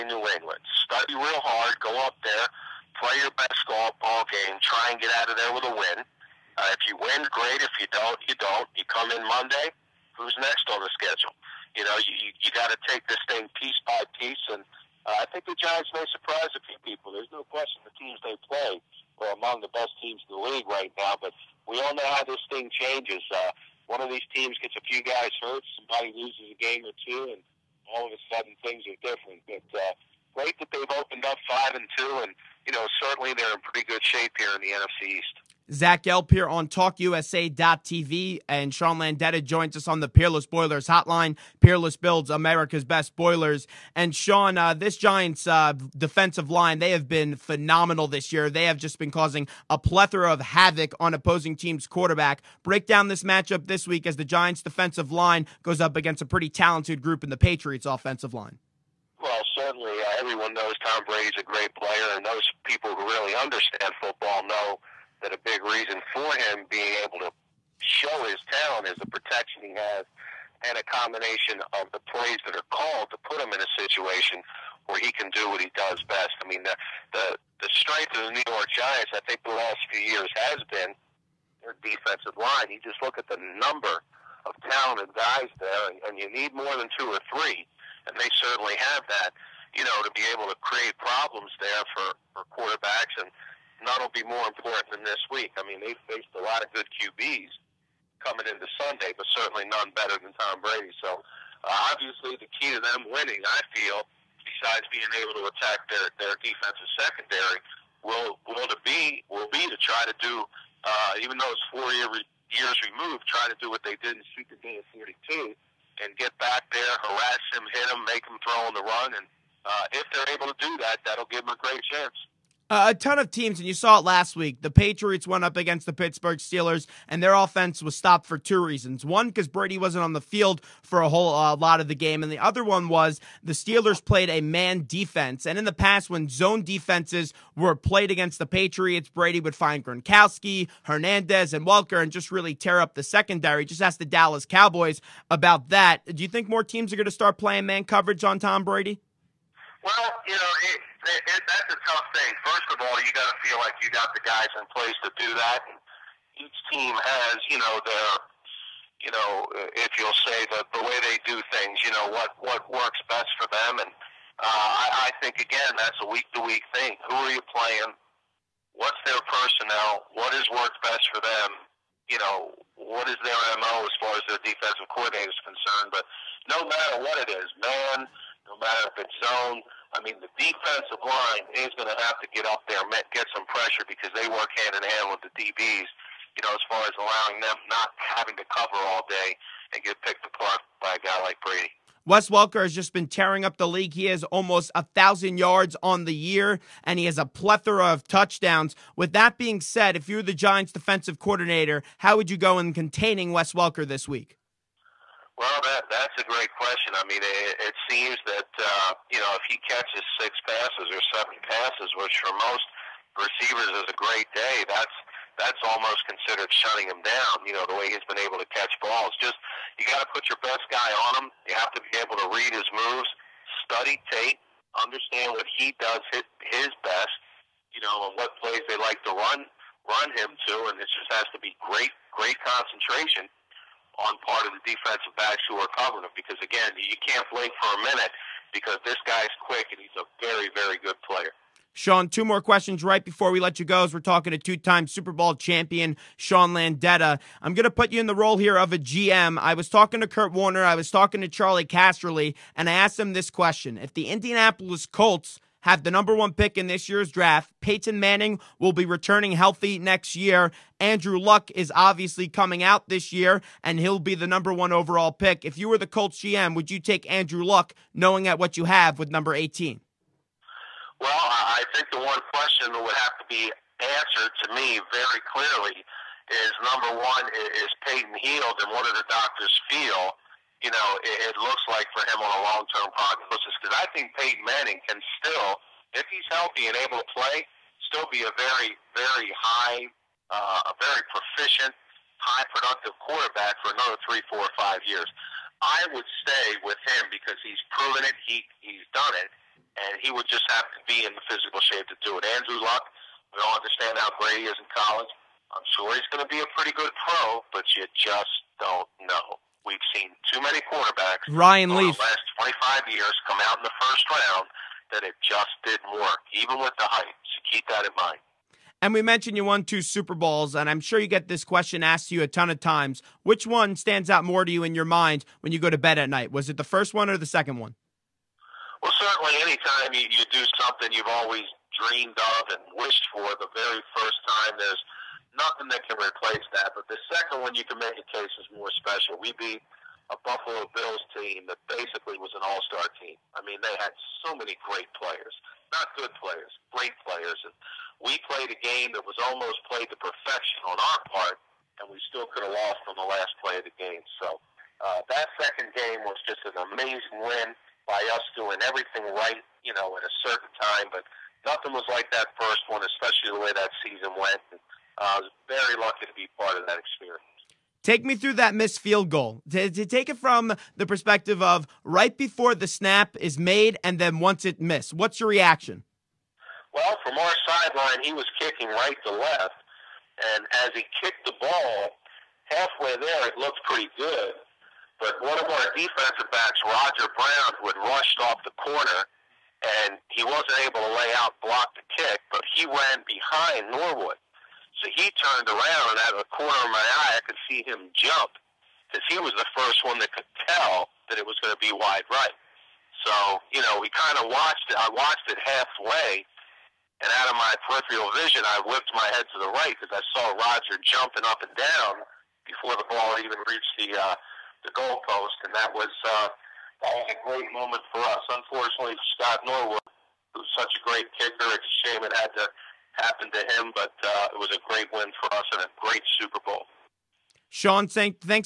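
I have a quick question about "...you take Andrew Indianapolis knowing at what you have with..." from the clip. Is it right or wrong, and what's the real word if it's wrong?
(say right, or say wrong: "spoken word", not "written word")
wrong: "Luck", not "Indianapolis".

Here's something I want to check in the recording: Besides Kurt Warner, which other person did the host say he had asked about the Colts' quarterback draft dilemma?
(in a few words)
Charlie Casserly.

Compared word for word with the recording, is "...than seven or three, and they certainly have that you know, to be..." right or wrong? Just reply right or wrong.
wrong.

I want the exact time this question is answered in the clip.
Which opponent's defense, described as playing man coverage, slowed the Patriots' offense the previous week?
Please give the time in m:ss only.
2:05.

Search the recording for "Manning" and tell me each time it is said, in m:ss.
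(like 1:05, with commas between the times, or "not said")
4:17, 4:44.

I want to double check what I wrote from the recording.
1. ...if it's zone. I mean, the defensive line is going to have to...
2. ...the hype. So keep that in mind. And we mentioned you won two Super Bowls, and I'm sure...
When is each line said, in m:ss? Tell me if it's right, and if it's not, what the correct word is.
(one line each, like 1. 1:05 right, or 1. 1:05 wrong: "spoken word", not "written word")
1. 2:58 right
2. 5:16 right.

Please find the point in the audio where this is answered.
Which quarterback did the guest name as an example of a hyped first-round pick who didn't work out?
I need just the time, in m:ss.
5:11.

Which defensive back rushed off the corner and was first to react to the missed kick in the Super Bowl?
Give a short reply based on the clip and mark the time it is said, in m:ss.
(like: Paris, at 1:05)
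Roger Brown, at 6:26.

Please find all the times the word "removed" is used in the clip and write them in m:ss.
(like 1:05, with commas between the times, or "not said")
1:52.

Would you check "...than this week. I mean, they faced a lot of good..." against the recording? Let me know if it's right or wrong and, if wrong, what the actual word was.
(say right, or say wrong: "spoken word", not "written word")
right.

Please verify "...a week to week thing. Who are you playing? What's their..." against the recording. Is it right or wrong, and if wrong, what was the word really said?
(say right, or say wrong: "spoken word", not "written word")
right.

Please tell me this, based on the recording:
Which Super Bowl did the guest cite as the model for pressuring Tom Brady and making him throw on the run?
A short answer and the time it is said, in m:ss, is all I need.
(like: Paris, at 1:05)
Super Bowl 42, at 1:54.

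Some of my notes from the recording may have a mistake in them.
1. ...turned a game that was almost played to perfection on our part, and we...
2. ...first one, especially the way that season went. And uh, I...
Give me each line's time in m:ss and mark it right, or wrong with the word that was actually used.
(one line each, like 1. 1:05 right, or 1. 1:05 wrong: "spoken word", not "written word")
1. 5:48 wrong: "played", not "turned"
2. 6:02 right.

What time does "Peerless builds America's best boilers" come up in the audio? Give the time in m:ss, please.
0:41.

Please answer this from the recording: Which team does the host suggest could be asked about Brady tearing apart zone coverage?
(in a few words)
Dallas Cowboys.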